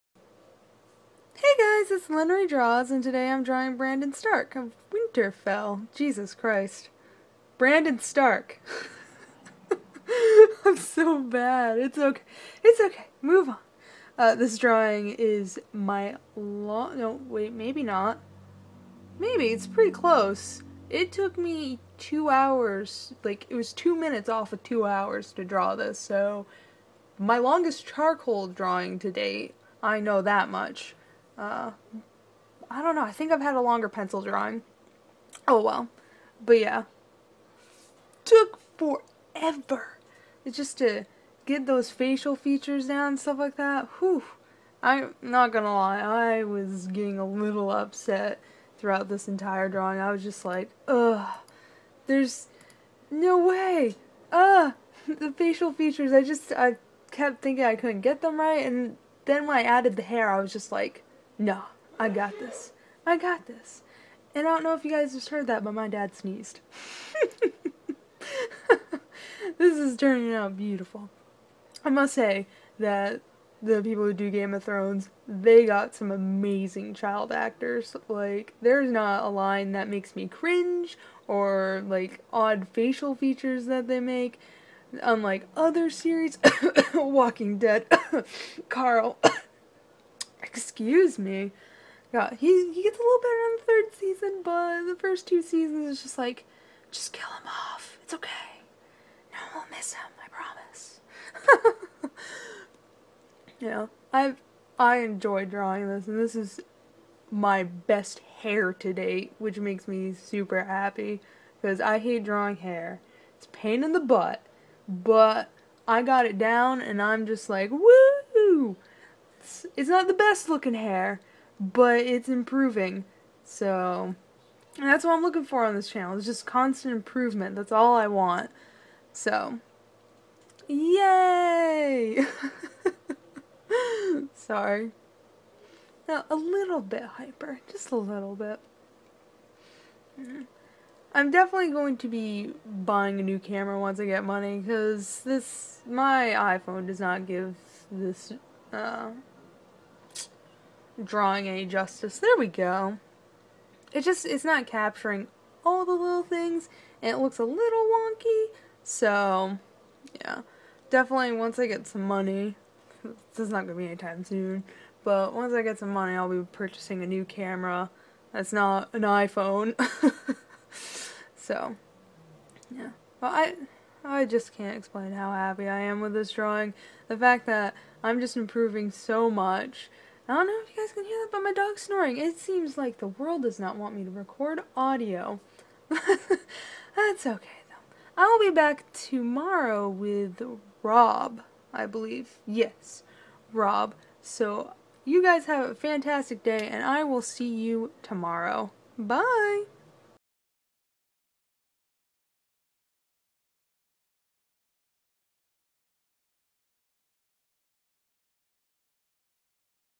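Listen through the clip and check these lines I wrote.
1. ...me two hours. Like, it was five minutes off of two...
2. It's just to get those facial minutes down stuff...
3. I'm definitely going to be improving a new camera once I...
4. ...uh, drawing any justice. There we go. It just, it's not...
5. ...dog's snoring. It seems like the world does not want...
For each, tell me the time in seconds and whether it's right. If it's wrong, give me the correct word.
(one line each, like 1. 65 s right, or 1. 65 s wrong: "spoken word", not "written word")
1. 21 s wrong: "two", not "five"
2. 40 s wrong: "features", not "minutes"
3. 141 s wrong: "buying", not "improving"
4. 148 s right
5. 181 s right.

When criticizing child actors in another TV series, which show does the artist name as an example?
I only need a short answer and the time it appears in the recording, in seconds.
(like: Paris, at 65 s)
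Walking Dead, at 86 s.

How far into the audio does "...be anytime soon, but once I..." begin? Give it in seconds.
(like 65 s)
163 s.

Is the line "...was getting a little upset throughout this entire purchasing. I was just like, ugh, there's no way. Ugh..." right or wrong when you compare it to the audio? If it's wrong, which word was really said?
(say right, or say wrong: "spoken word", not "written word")
wrong: "drawing", not "purchasing".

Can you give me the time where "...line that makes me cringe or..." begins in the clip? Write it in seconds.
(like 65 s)
79 s.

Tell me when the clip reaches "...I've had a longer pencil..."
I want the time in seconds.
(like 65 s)
33 s.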